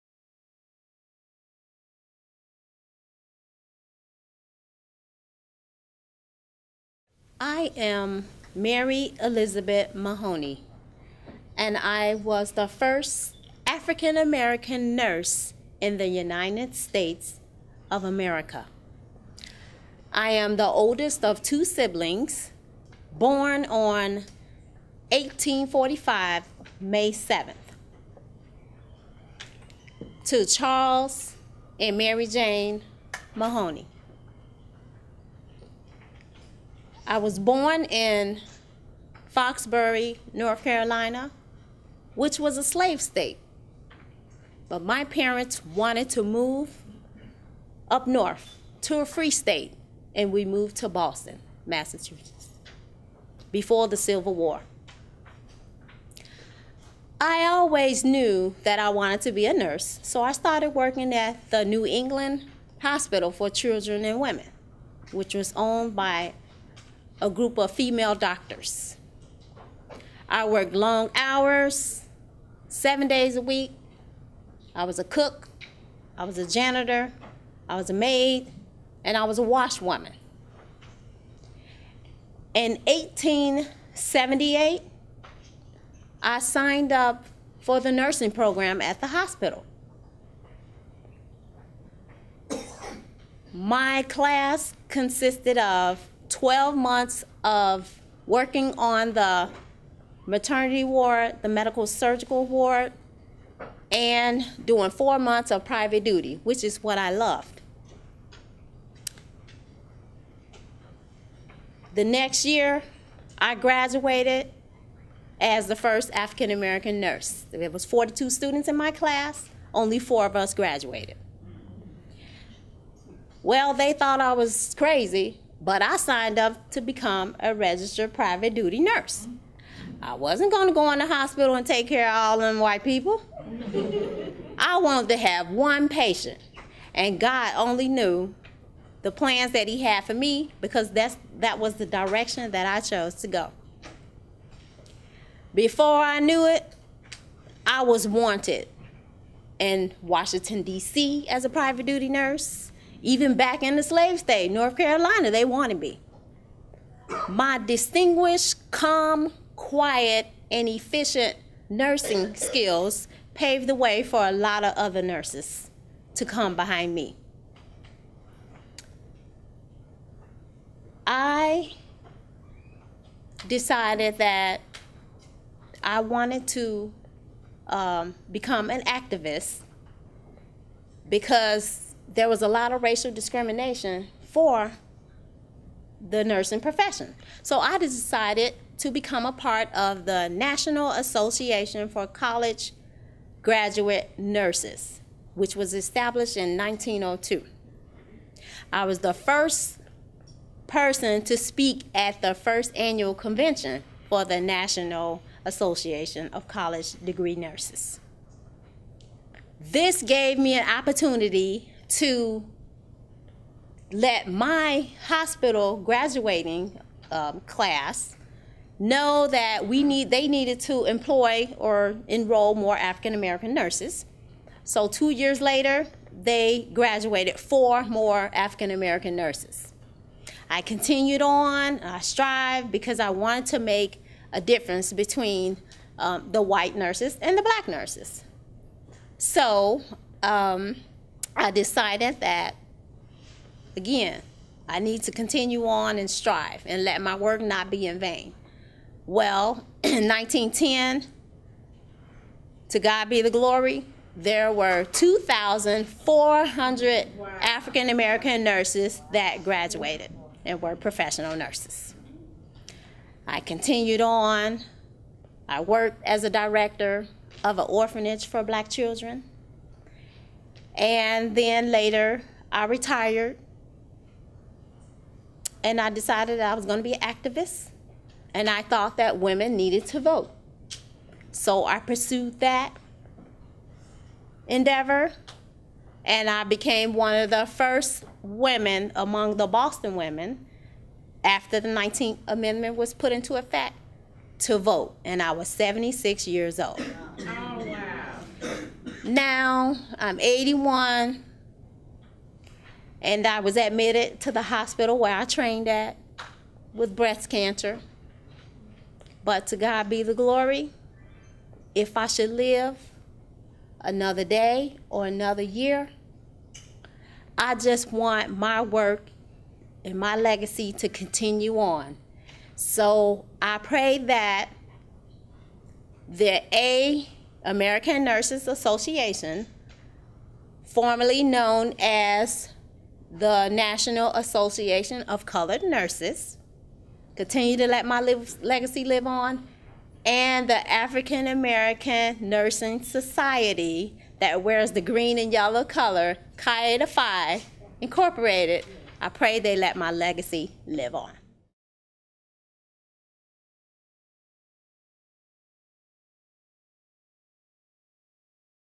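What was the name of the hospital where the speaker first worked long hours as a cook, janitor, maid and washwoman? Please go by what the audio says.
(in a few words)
New England Hospital for Children and Women.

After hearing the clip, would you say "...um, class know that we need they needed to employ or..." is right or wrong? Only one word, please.
right.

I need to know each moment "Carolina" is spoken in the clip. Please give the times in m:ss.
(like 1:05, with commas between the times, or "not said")
0:40, 2:34.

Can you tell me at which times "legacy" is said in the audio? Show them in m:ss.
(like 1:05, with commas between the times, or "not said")
5:20, 5:38, 5:49.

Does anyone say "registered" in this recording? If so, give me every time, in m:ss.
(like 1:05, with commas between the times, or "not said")
2:07.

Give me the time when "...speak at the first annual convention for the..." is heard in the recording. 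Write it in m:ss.
3:21.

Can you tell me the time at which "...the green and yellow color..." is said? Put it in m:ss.
5:44.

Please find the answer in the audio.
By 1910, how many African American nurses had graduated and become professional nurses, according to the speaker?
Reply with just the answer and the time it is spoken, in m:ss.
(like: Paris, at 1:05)
2,400, at 4:14.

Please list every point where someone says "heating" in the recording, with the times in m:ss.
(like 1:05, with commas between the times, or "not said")
not said.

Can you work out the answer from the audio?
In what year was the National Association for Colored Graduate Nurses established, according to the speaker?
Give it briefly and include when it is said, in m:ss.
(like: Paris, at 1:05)
1902, at 3:16.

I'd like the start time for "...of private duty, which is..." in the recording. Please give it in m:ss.
1:45.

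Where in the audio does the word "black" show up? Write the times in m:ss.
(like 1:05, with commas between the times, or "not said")
3:57, 4:28.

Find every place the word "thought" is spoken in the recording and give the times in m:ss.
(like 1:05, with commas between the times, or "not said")
2:03, 4:38.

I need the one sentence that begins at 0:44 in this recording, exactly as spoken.
But my parents wanted to move up north to a free state, and we moved to Boston, Massachusetts, before the Civil War.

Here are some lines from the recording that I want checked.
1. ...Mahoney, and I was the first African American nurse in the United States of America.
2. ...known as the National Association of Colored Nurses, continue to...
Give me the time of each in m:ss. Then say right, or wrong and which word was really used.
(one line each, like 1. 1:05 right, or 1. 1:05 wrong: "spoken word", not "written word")
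1. 0:09 right
2. 5:31 right.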